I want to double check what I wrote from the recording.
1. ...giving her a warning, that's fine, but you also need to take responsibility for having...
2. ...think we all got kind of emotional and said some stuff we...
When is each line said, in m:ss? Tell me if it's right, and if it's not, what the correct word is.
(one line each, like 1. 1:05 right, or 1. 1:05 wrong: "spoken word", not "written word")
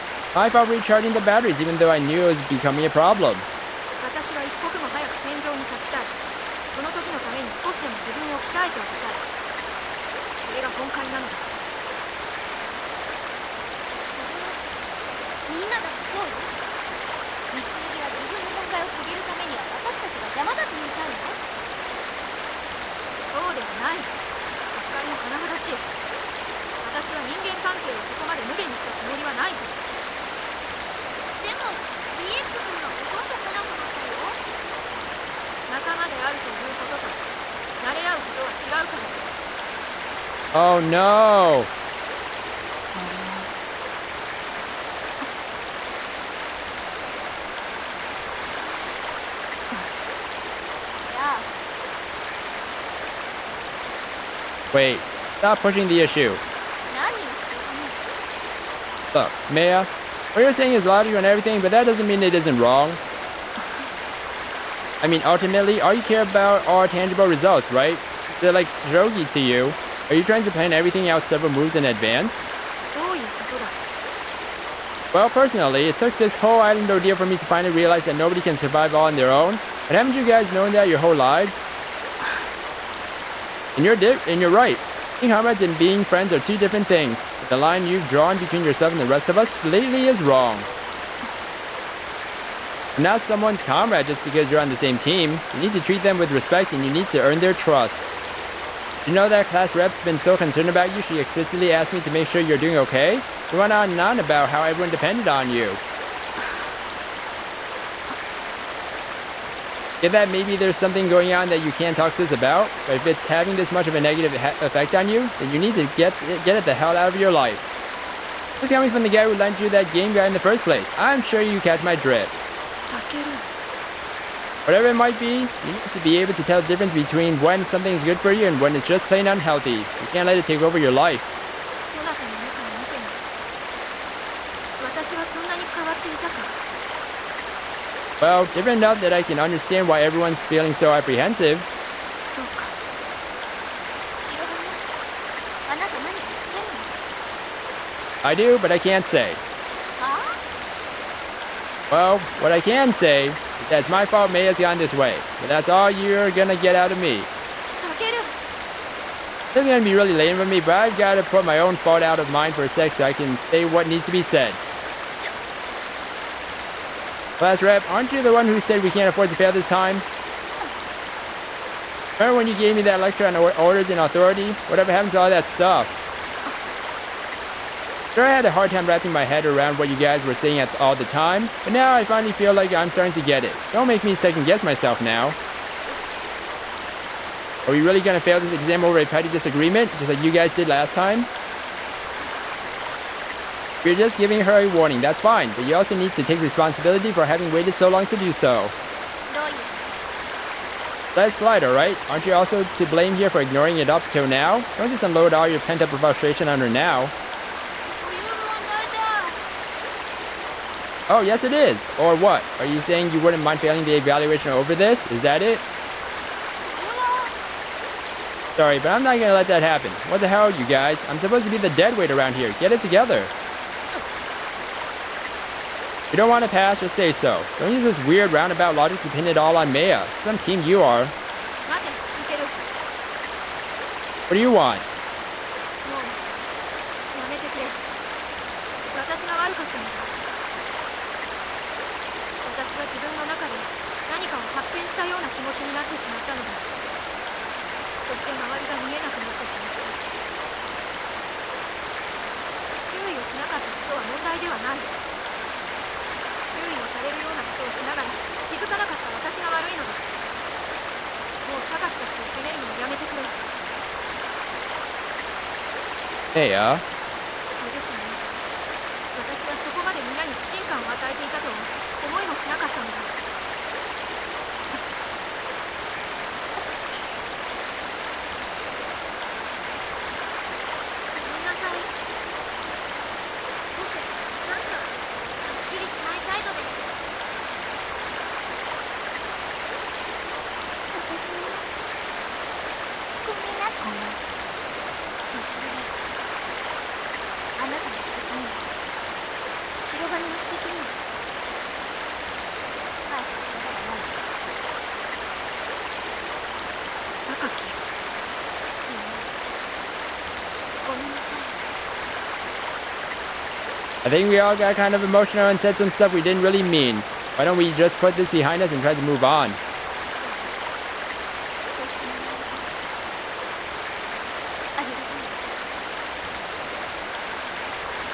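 1. 3:14 right
2. 5:14 right.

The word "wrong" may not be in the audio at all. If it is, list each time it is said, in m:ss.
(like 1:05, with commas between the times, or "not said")
1:02, 1:30.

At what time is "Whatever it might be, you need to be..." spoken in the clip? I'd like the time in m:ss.
2:04.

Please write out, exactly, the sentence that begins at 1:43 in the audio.
You went on and on about how everyone depended on you.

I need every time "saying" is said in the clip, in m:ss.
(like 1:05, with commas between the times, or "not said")
1:00, 3:00, 3:32.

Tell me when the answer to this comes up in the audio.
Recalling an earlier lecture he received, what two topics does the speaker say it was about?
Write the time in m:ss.
2:53.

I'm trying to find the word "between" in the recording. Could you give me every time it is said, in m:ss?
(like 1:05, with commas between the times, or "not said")
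1:28, 2:06.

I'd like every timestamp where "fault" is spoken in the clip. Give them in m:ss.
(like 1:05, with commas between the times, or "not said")
0:00, 2:34, 2:41.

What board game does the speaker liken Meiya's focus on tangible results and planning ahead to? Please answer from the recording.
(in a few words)
Shogi.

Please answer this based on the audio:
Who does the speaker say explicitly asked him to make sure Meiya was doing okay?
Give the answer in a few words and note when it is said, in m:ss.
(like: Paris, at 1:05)
Class rep, at 1:39.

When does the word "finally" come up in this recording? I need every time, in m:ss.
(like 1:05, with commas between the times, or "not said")
1:17, 3:02.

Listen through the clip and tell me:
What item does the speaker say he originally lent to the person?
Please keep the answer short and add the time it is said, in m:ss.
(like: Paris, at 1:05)
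That game, at 1:59.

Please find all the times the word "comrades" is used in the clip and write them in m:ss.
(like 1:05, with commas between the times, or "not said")
1:25, 1:33.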